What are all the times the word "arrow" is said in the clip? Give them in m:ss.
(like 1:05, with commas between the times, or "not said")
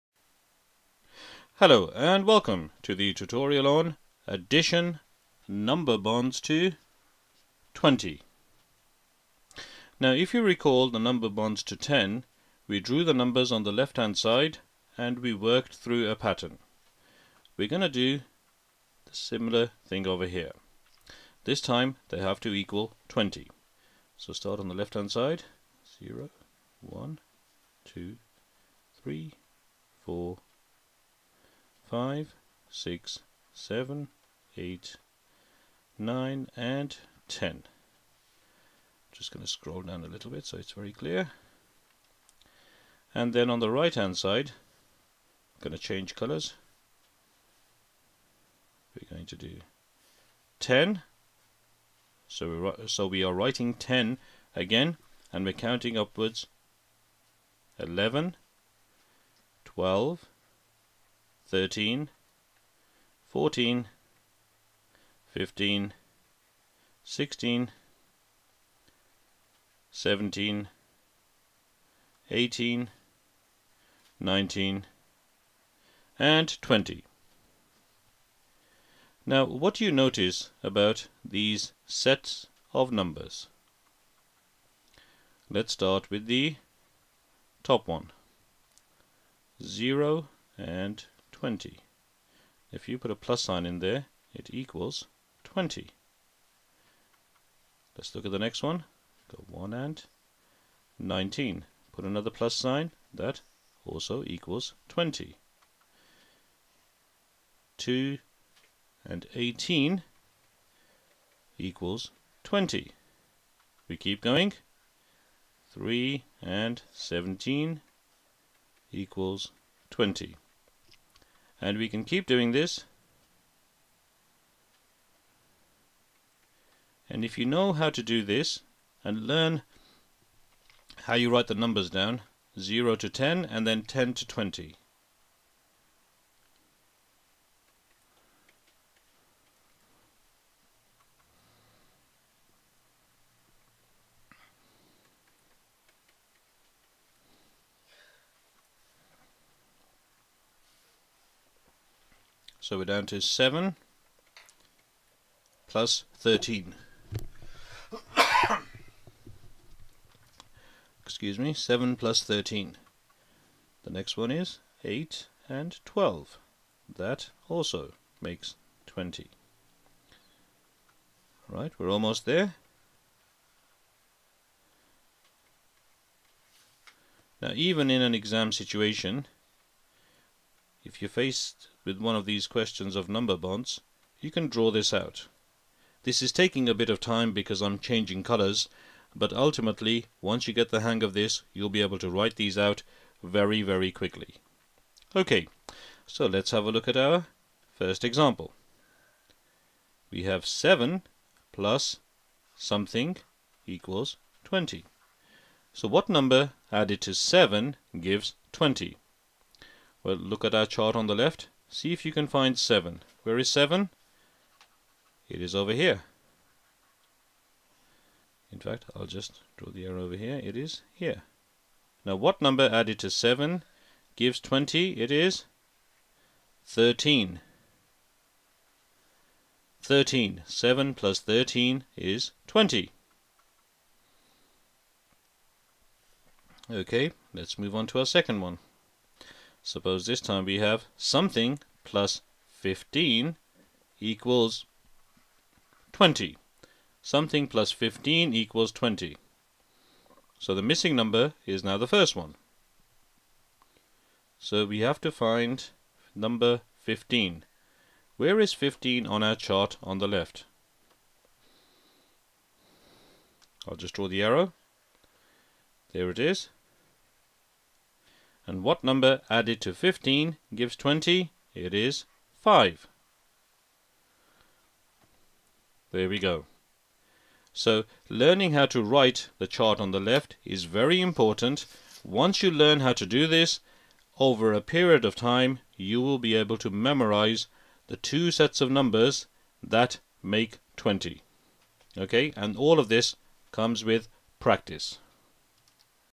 3:39, 4:24.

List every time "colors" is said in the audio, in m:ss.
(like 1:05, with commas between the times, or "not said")
0:46, 3:08.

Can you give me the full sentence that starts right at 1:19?
Now, what do you notice about these sets of numbers?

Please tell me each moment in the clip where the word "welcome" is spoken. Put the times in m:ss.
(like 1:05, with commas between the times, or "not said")
0:02.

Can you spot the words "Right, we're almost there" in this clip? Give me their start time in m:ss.
2:51.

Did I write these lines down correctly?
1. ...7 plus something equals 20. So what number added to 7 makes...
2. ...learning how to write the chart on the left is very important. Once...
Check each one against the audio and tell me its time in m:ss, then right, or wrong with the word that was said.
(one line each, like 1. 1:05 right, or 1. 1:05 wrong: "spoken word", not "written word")
1. 3:20 wrong: "gives", not "makes"
2. 4:38 right.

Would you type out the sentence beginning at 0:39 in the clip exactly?
Just going to scroll down a little bit so it's very clear.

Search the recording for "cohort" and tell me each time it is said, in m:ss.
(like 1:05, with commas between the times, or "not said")
not said.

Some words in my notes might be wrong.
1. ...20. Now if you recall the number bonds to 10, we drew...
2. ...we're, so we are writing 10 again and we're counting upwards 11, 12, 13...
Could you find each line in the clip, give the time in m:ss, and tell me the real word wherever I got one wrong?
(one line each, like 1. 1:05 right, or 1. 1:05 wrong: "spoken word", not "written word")
1. 0:07 right
2. 0:52 right.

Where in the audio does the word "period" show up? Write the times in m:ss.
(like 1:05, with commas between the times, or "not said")
4:44.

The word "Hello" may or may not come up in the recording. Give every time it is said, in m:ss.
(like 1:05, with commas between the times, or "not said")
0:01.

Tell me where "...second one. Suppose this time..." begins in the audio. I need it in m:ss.
3:58.